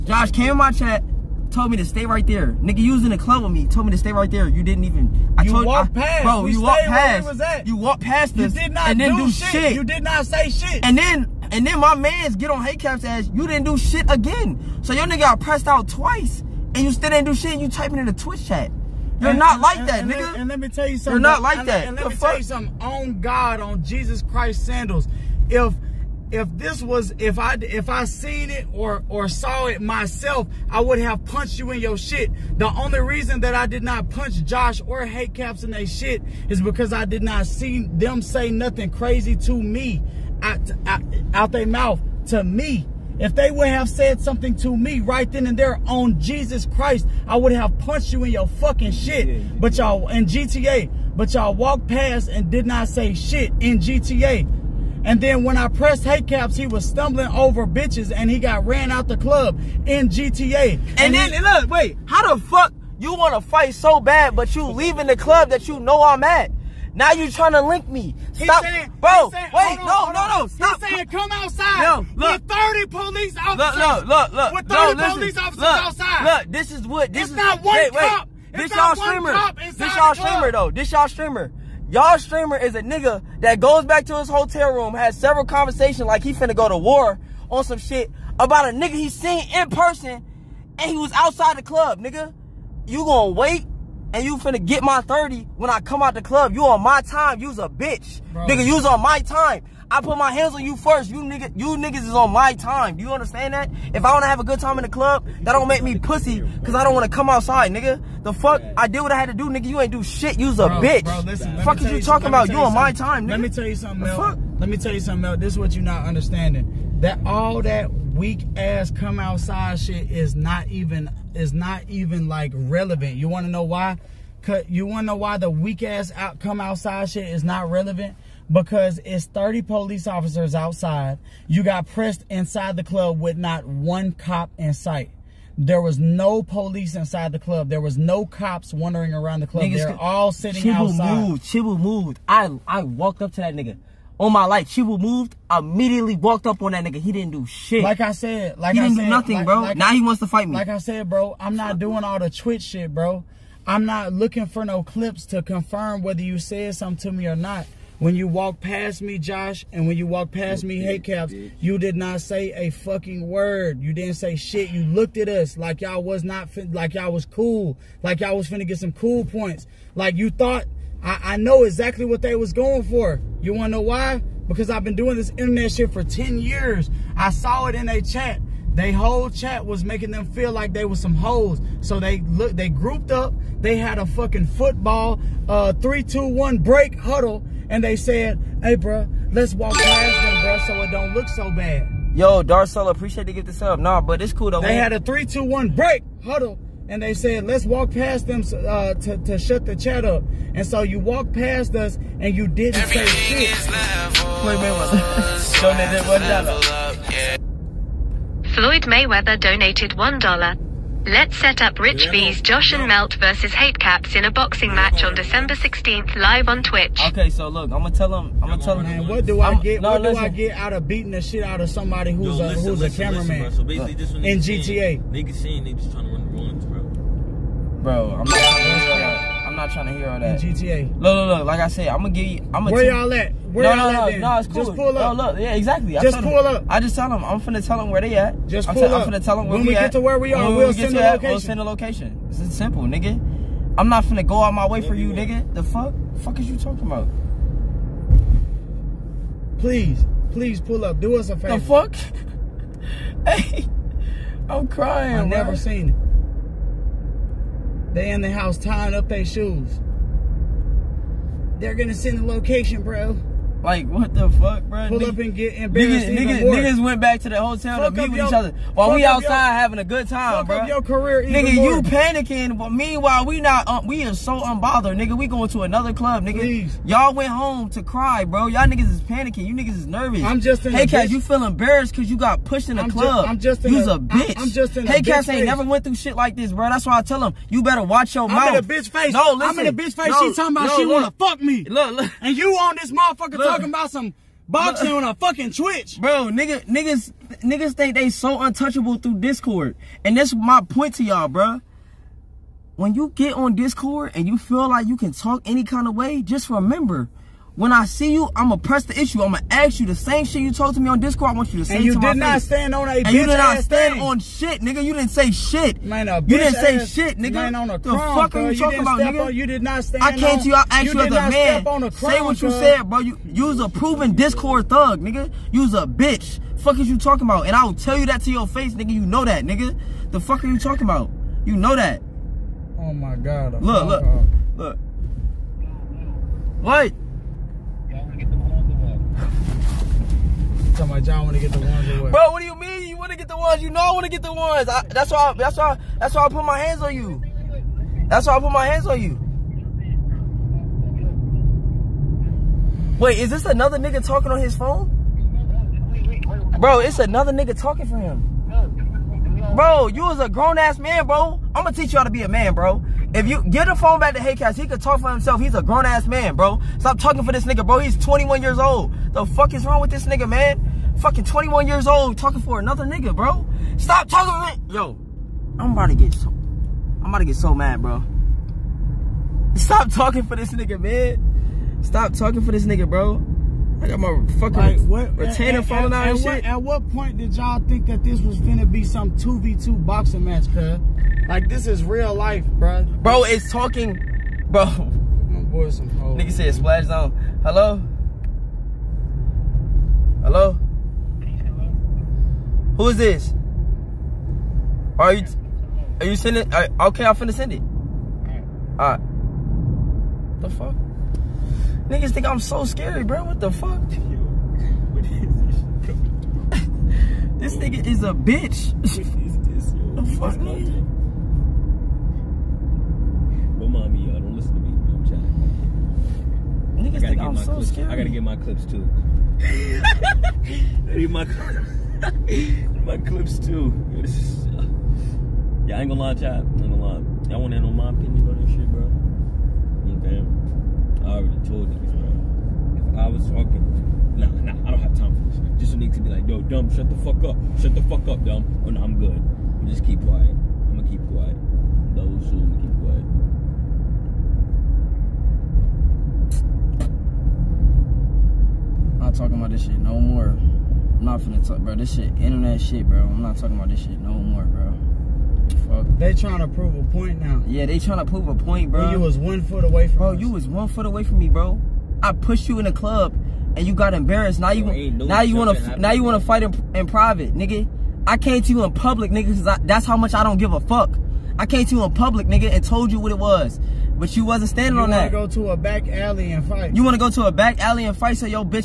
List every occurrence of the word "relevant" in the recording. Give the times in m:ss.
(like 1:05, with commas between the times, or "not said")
2:02, 2:07.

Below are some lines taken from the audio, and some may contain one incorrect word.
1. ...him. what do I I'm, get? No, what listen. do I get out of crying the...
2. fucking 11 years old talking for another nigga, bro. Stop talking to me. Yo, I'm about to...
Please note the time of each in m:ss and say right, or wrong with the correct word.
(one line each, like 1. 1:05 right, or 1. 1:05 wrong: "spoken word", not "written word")
1. 3:38 wrong: "beating", not "crying"
2. 6:10 wrong: "21", not "11".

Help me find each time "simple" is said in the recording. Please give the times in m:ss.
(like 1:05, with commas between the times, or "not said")
4:02.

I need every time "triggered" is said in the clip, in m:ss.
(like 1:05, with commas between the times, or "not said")
not said.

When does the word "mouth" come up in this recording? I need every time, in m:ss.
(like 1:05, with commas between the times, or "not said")
0:41, 4:48.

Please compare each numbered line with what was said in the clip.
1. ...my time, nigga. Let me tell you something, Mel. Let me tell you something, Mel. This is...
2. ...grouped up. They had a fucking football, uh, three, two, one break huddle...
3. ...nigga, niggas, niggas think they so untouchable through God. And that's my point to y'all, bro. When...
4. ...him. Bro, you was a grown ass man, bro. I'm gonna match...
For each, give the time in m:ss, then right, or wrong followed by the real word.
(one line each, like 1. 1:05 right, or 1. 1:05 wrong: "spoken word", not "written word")
1. 1:52 right
2. 3:02 right
3. 4:56 wrong: "Discord", not "God"
4. 5:57 wrong: "teach", not "match".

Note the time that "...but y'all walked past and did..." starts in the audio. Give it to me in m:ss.
0:51.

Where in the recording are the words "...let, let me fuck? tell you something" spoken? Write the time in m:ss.
0:21.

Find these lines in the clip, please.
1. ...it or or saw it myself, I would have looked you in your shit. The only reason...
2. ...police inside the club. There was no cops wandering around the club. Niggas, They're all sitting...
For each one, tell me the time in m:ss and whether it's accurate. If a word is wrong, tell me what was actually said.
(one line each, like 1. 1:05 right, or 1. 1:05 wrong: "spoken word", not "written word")
1. 0:28 wrong: "punched", not "looked"
2. 2:16 right.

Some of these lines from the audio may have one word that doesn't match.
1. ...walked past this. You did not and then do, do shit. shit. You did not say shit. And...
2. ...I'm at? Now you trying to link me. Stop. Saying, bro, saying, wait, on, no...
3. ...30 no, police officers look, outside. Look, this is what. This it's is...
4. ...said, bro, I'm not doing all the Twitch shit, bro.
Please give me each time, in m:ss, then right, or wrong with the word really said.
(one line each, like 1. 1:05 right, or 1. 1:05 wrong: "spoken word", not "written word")
1. 0:07 right
2. 1:06 right
3. 1:14 right
4. 2:30 right.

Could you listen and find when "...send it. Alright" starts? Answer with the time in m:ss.
6:47.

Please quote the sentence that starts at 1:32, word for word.
You gonna wait and you finna get my 30 when I come out the club.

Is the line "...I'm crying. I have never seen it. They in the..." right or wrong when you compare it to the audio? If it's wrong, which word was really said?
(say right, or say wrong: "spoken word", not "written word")
right.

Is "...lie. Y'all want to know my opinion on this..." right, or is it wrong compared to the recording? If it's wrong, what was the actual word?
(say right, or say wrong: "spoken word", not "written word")
right.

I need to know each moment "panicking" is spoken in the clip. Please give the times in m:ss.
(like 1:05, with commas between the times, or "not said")
4:31, 4:39.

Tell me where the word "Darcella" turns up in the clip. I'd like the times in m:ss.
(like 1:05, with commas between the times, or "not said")
3:12.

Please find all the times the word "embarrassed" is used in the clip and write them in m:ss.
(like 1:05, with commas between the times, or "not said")
4:25, 4:41, 7:53.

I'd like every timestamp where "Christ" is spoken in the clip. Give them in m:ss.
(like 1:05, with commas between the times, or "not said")
0:24, 0:46.